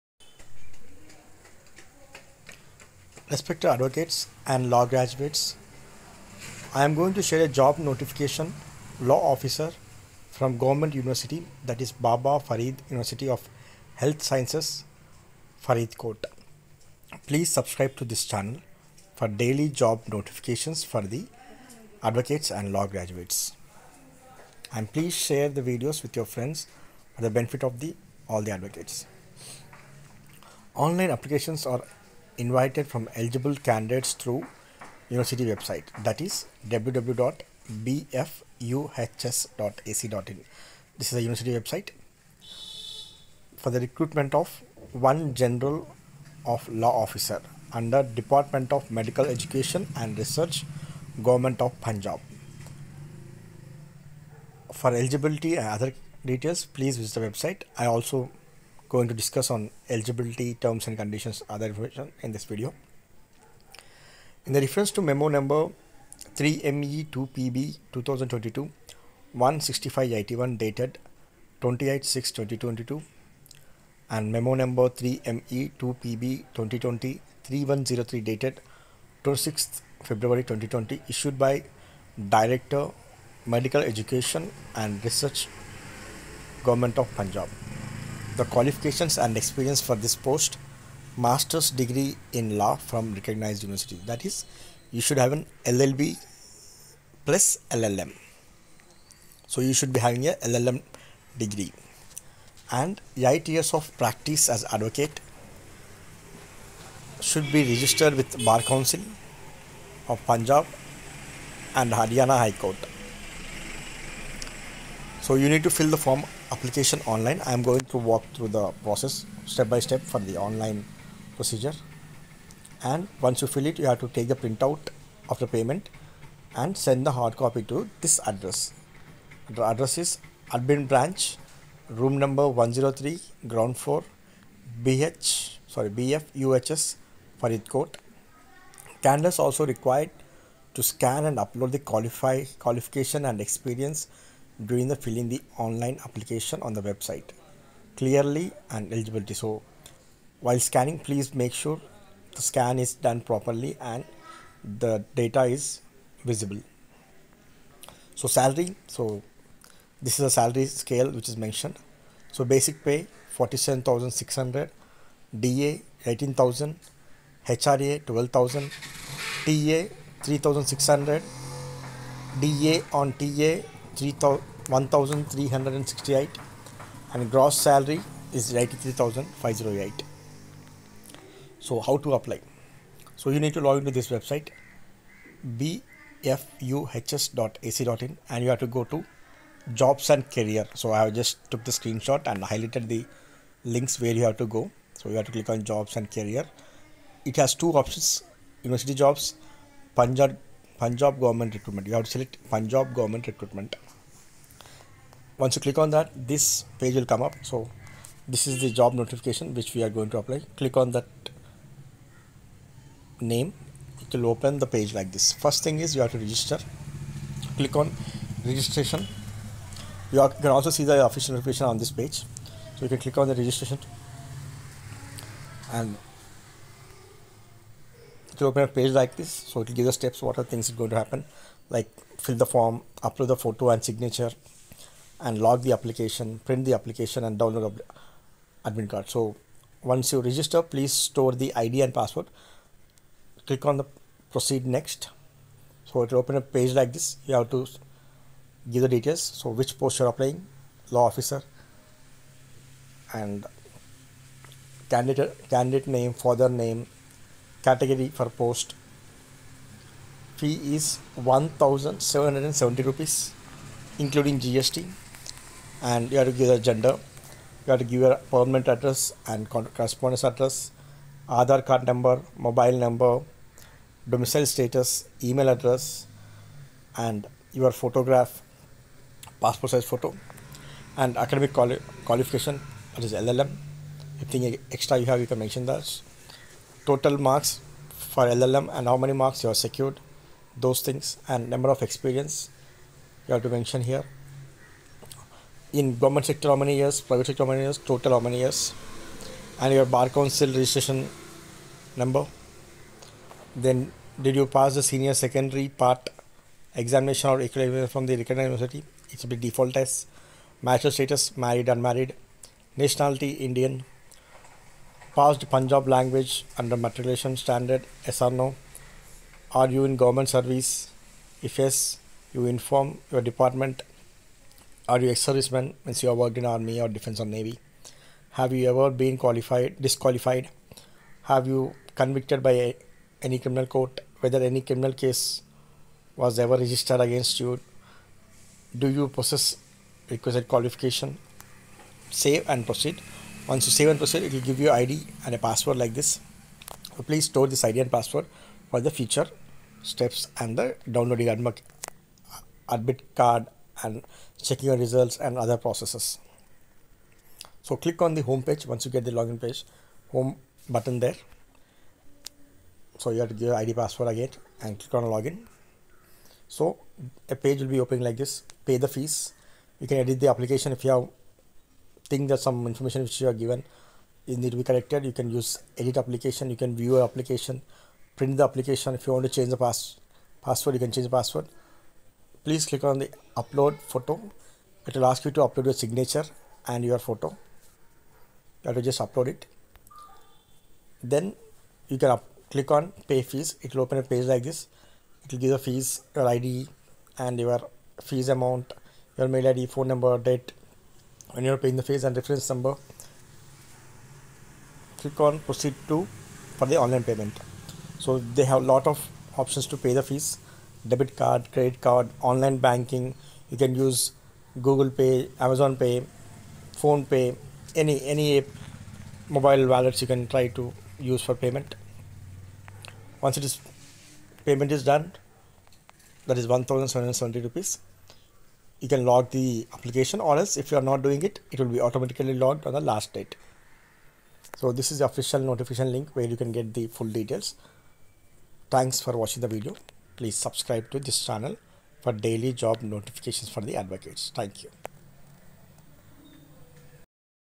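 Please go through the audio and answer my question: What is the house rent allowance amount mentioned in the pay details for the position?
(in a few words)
12000.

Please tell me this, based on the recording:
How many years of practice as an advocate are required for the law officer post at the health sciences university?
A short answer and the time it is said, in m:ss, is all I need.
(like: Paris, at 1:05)
8, at 1:43.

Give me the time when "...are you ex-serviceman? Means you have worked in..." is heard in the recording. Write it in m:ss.
5:24.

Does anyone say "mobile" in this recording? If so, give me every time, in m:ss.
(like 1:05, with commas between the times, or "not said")
4:32, 6:59.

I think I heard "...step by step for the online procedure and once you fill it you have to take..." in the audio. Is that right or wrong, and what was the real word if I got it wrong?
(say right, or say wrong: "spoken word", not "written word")
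right.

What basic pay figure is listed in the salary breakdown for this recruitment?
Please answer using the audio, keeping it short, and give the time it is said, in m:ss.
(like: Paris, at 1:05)
47600, at 2:43.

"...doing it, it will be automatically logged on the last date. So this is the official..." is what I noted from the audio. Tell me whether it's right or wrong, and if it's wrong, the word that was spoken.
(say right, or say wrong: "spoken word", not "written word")
right.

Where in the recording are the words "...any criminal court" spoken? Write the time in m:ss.
5:33.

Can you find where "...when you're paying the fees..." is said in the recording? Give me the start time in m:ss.
6:41.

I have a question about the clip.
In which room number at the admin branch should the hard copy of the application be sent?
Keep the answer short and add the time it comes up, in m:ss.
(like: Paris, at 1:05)
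103, at 2:12.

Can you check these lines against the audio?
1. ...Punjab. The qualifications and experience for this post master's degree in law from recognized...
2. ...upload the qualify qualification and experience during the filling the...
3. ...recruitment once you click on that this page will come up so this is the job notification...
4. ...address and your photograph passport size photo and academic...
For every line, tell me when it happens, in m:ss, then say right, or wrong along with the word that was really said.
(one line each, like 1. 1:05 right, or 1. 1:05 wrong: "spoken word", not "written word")
1. 1:27 right
2. 2:21 right
3. 3:23 right
4. 4:35 right.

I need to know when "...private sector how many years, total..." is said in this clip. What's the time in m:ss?
4:57.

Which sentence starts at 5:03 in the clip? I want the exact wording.
Then did you pass the senior secondary part examination or equivalent from the recognized university?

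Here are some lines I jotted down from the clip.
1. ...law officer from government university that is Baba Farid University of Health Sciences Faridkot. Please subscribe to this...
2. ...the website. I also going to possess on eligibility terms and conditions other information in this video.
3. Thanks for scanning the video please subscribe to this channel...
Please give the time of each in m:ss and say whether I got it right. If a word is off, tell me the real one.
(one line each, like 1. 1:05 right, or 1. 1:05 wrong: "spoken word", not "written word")
1. 0:08 right
2. 0:57 wrong: "discuss", not "possess"
3. 7:18 wrong: "watching", not "scanning".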